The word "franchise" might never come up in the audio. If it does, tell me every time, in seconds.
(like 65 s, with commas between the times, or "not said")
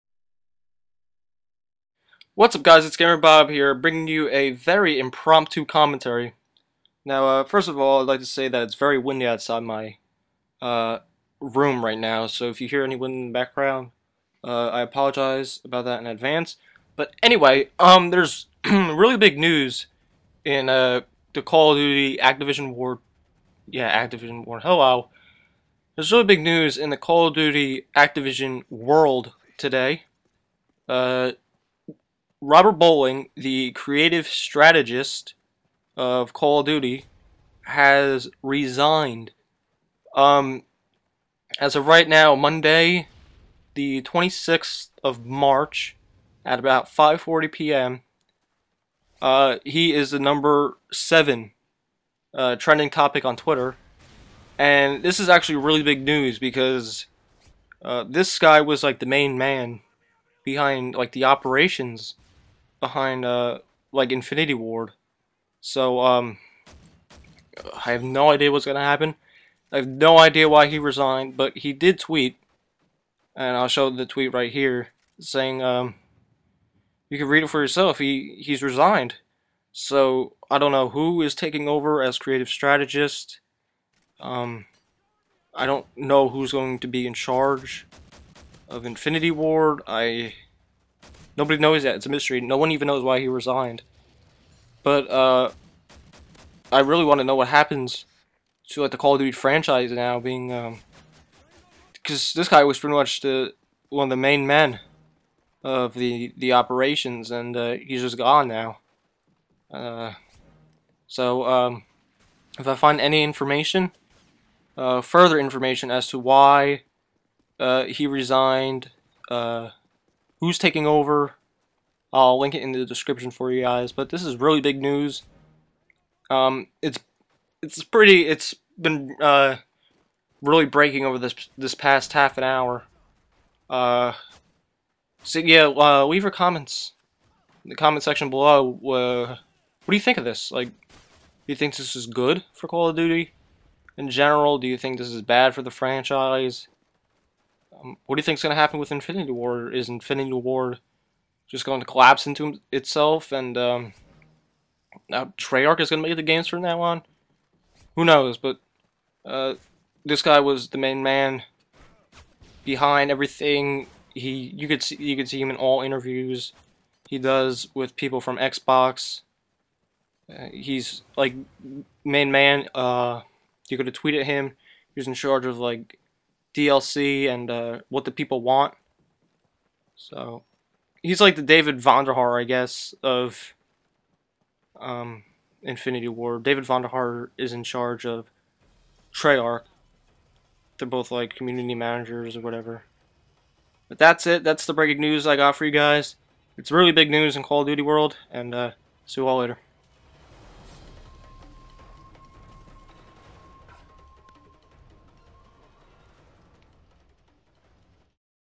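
99 s, 145 s.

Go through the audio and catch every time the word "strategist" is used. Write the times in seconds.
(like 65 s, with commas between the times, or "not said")
34 s, 82 s.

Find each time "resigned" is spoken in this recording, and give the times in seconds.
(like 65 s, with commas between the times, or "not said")
38 s, 70 s, 78 s, 93 s, 118 s.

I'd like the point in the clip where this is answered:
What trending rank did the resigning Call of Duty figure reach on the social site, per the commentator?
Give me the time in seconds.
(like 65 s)
50 s.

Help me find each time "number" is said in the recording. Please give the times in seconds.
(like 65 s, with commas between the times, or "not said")
50 s.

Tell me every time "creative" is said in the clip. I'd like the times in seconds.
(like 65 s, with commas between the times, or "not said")
33 s, 82 s.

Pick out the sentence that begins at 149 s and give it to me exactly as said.
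Is Infinity War just going to collapse into itself and um, now Treyarch is going to make the games from now on?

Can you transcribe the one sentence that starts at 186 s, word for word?
David Vonderhaar is in charge of Treyarch.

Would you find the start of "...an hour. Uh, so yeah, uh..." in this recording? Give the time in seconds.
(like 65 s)
132 s.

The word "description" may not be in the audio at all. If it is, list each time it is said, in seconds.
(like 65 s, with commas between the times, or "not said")
122 s.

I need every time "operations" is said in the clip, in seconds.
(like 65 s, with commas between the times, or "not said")
61 s, 106 s.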